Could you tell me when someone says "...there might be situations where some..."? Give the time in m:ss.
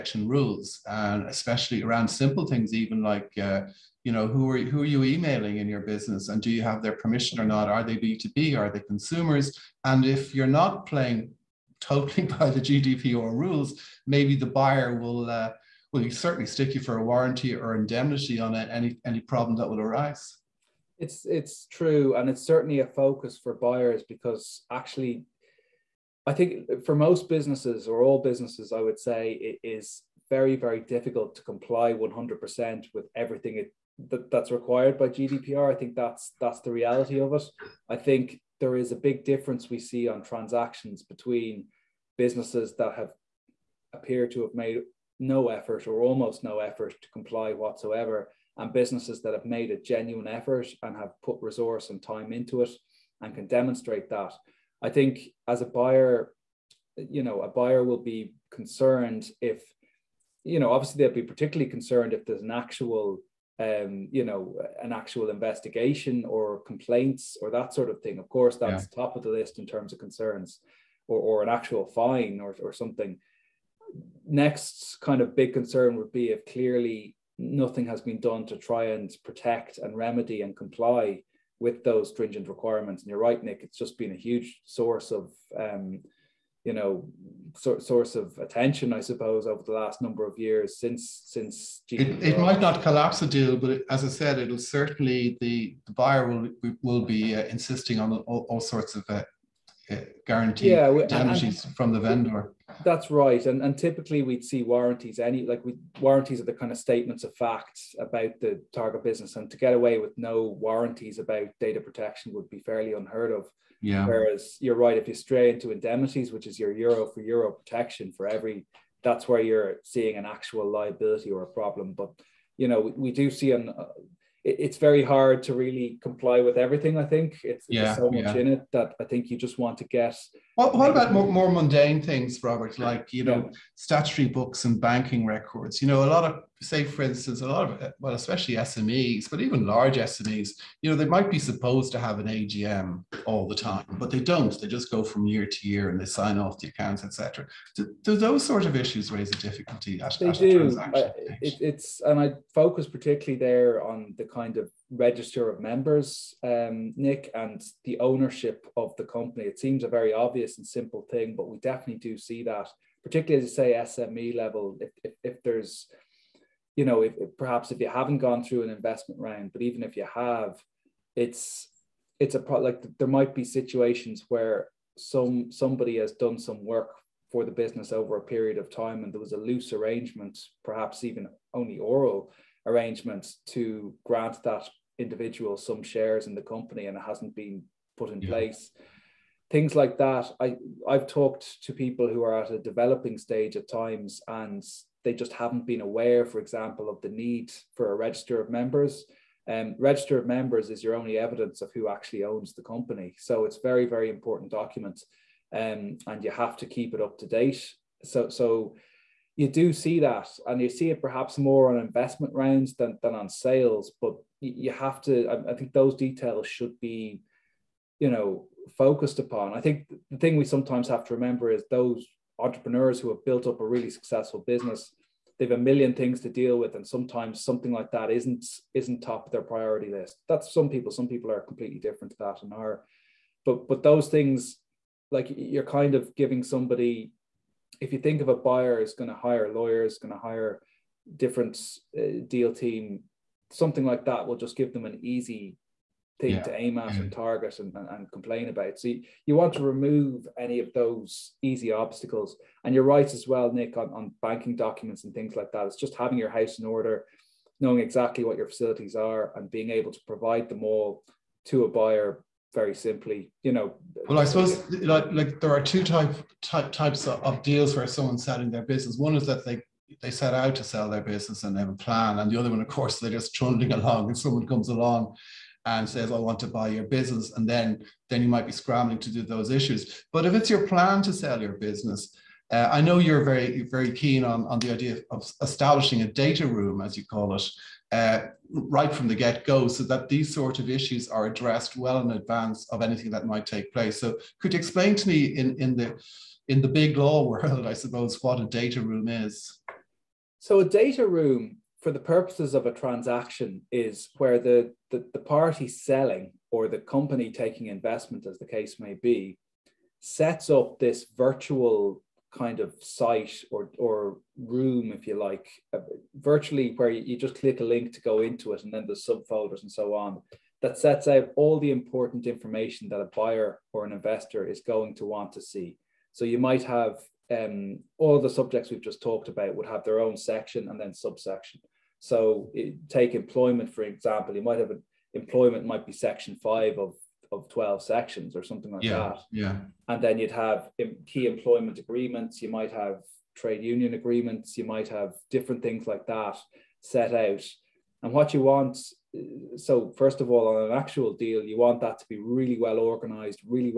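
2:52.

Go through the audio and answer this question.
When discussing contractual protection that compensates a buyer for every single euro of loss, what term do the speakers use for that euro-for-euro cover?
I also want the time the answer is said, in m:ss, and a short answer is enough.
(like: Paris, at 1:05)
Indemnities, at 1:55.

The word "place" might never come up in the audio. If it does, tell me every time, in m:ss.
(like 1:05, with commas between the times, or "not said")
3:08, 4:53.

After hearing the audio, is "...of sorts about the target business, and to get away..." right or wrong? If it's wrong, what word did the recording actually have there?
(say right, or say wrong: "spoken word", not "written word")
wrong: "facts", not "sorts".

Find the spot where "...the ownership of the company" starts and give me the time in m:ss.
2:37.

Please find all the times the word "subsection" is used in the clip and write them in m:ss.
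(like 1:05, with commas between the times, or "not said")
5:30.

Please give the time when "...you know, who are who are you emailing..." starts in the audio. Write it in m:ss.
0:04.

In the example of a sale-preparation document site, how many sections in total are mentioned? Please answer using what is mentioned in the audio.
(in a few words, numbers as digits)
12.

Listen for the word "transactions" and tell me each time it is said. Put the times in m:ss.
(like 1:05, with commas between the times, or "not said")
0:40, 5:02.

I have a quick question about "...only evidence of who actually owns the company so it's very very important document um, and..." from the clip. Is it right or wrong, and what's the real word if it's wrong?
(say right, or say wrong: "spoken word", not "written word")
right.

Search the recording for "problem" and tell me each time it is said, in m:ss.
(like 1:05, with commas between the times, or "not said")
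0:19, 2:01.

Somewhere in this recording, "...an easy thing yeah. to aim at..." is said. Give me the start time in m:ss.
4:04.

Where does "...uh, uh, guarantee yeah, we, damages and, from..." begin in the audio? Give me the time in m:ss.
1:39.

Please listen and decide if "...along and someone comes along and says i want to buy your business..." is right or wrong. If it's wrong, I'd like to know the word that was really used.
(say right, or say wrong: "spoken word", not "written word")
right.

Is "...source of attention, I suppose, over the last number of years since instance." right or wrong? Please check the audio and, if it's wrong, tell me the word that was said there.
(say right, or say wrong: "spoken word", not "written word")
wrong: "since", not "instance".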